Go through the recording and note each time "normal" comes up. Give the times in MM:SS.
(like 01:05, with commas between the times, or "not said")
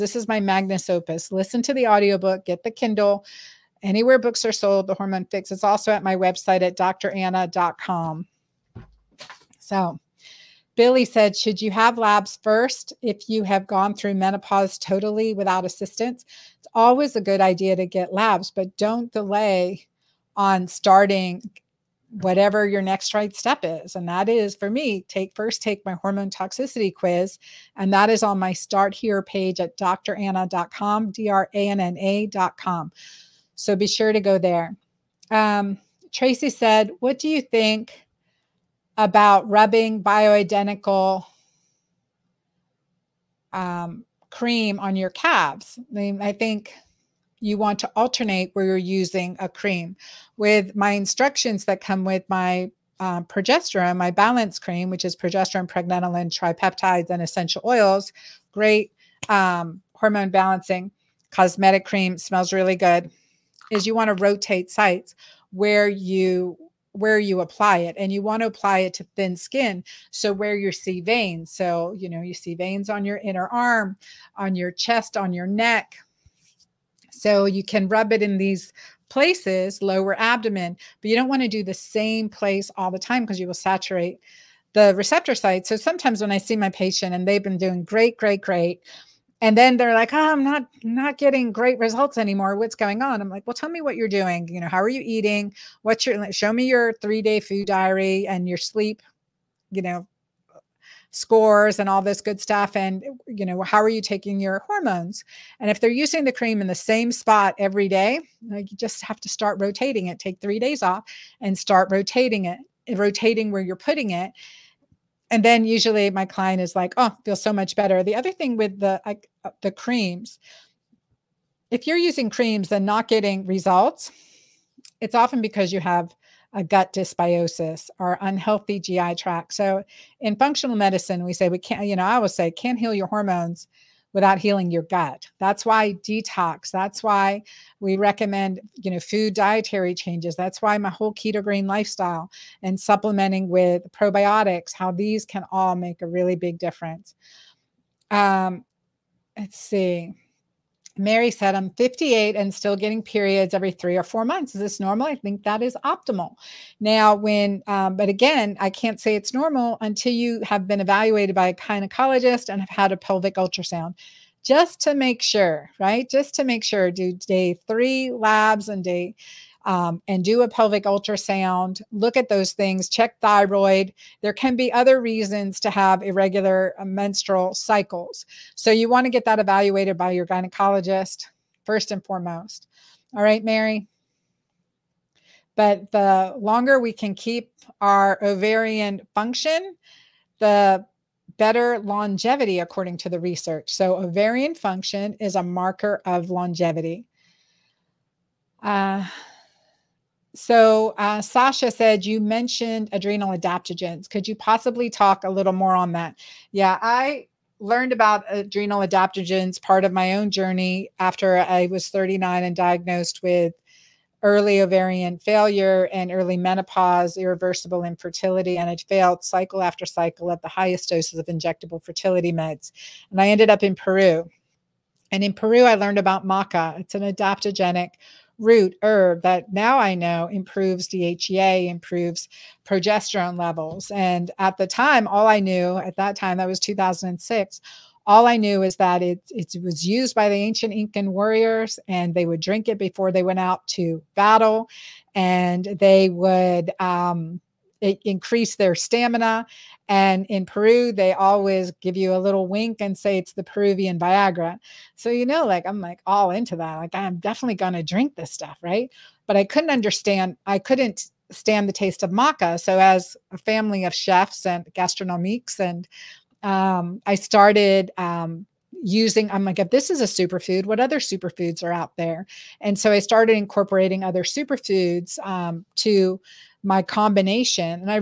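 02:34, 02:39.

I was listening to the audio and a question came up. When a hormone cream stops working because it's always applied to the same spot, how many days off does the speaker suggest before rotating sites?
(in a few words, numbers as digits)
3.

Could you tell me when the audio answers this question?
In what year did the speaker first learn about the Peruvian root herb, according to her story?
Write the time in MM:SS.
03:56.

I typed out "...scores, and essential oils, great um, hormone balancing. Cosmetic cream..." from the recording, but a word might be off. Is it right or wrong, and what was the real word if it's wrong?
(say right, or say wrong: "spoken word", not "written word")
wrong: "tripeptides", not "scores".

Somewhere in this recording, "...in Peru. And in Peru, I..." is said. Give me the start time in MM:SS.
03:43.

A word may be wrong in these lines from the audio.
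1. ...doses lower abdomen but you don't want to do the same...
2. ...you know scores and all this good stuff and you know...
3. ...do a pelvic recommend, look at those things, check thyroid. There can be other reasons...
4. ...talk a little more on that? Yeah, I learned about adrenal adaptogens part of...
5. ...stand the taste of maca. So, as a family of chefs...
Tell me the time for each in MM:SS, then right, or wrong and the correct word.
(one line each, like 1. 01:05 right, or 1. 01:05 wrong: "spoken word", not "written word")
1. 01:19 wrong: "places", not "doses"
2. 01:39 right
3. 02:50 wrong: "ultrasound", not "recommend"
4. 03:24 right
5. 04:21 right.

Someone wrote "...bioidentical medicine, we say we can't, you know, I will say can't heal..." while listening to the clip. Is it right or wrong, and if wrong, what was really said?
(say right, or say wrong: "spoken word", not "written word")
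wrong: "functional", not "bioidentical".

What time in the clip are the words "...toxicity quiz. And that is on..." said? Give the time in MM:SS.
00:26.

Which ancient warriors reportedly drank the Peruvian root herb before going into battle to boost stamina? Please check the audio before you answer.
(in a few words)
Incan warriors.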